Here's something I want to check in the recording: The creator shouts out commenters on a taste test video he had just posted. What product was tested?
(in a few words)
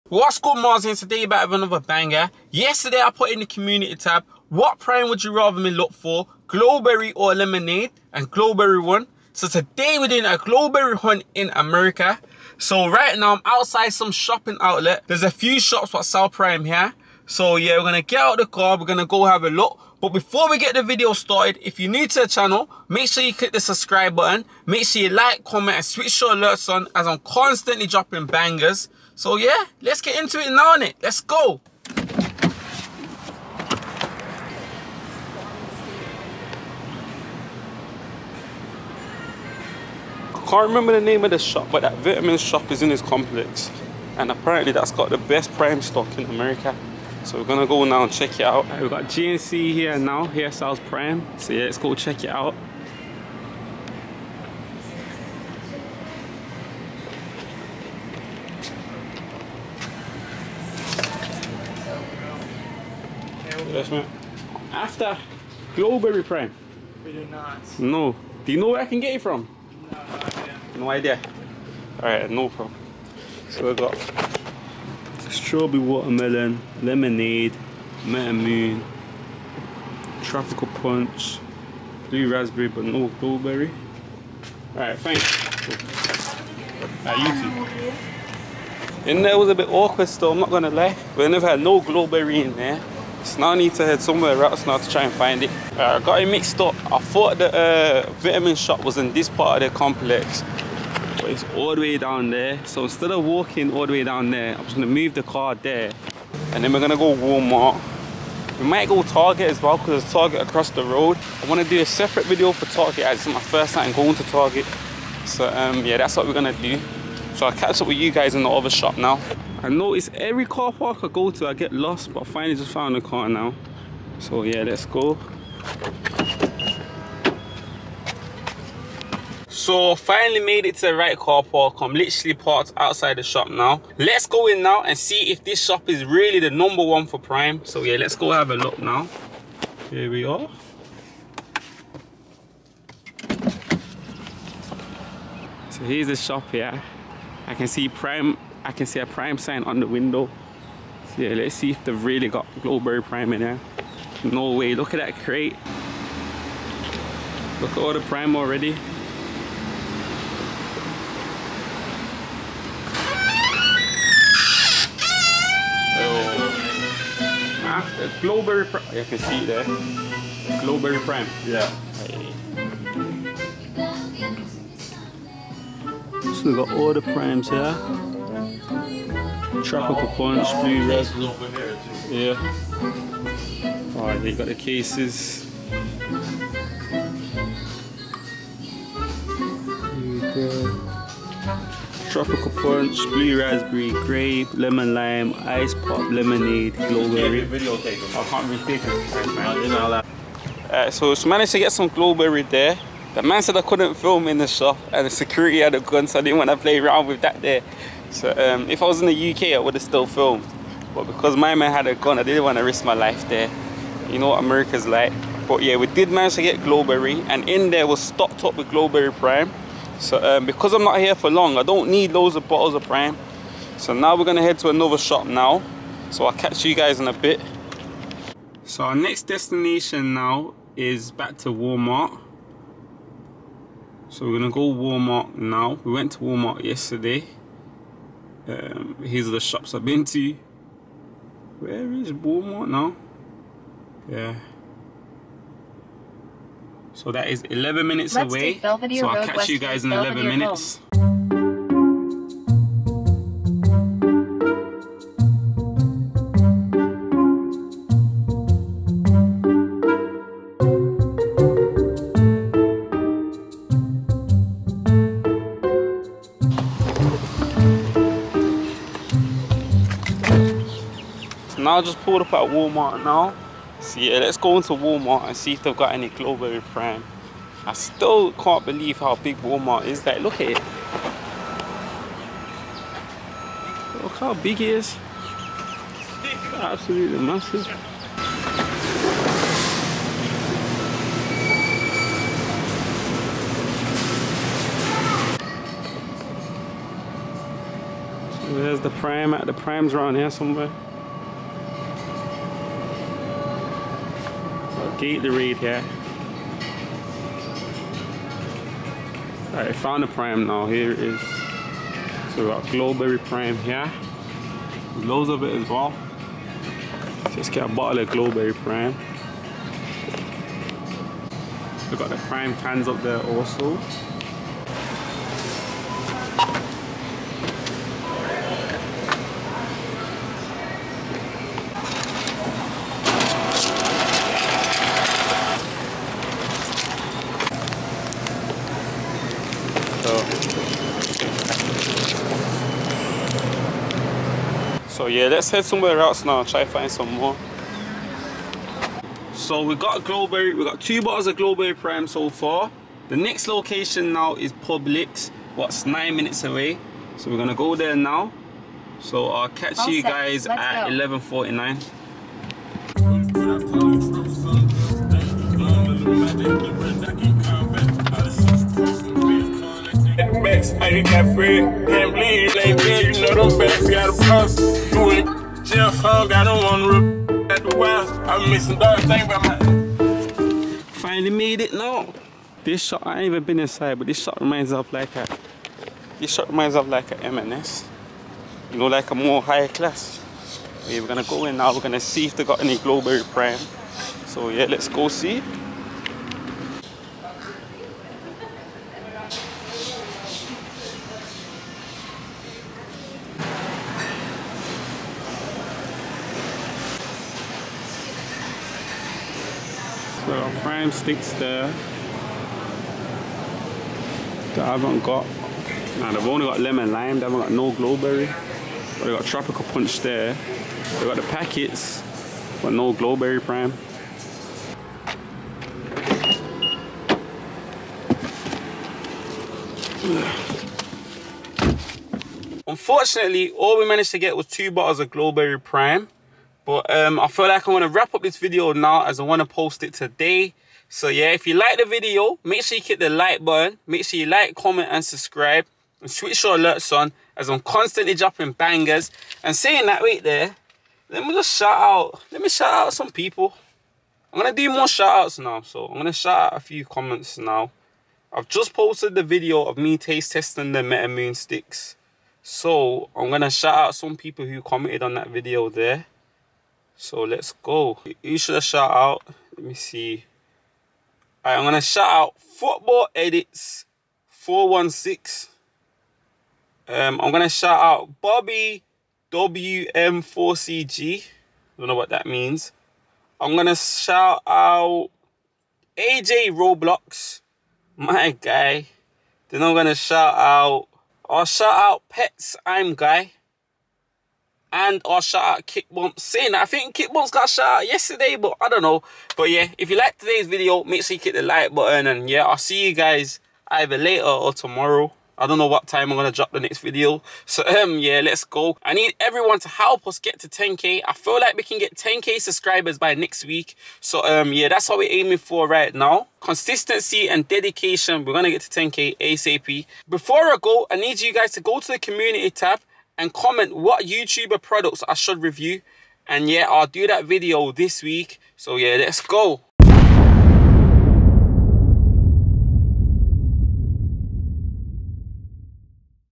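Meta Moon sticks.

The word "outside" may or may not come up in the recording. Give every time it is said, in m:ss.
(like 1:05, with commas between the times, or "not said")
0:13, 2:12.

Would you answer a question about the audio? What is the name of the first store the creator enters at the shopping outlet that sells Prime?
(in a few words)
GNC.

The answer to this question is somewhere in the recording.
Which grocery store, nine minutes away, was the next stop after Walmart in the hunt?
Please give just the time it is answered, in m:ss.
5:54.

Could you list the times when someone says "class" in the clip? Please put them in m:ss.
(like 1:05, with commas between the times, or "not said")
6:29.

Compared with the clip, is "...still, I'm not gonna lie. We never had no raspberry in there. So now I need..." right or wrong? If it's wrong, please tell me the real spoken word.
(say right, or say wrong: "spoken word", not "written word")
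wrong: "blueberry", not "raspberry".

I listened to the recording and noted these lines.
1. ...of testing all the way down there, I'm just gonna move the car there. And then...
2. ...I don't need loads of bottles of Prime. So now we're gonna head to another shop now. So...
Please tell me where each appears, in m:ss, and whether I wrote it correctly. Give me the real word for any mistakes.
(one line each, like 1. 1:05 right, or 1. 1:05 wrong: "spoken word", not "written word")
1. 1:43 wrong: "walking", not "testing"
2. 3:41 right.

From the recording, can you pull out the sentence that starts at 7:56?
Um, I'm gonna shout out Bobby WM4CG.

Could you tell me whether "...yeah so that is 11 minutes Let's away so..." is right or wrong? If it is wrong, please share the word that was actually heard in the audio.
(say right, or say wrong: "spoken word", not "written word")
right.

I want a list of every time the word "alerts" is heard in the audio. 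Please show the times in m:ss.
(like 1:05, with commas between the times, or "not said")
0:26, 7:26.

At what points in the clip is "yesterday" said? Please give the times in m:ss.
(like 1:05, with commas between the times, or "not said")
0:02, 3:56, 8:17.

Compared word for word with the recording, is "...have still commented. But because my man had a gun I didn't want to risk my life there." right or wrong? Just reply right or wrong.
wrong.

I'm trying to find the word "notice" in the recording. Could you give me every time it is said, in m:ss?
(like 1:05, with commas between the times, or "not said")
1:59.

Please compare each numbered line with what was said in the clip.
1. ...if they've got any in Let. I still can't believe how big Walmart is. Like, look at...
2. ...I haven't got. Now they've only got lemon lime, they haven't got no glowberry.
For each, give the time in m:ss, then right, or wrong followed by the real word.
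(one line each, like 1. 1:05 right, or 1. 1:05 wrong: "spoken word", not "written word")
1. 4:35 wrong: "Prime", not "Let"
2. 6:54 right.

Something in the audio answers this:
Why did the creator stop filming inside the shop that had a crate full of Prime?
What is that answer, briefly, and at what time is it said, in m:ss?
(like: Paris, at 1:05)
security had a gun, at 3:25.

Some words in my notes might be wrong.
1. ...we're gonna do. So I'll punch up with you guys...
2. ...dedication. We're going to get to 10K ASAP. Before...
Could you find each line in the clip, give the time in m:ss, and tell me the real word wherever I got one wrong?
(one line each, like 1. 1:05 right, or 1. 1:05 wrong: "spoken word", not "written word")
1. 1:56 wrong: "catch", not "punch"
2. 8:37 right.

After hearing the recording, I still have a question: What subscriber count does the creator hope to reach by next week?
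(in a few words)
10K.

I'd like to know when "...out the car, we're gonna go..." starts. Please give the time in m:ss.
0:18.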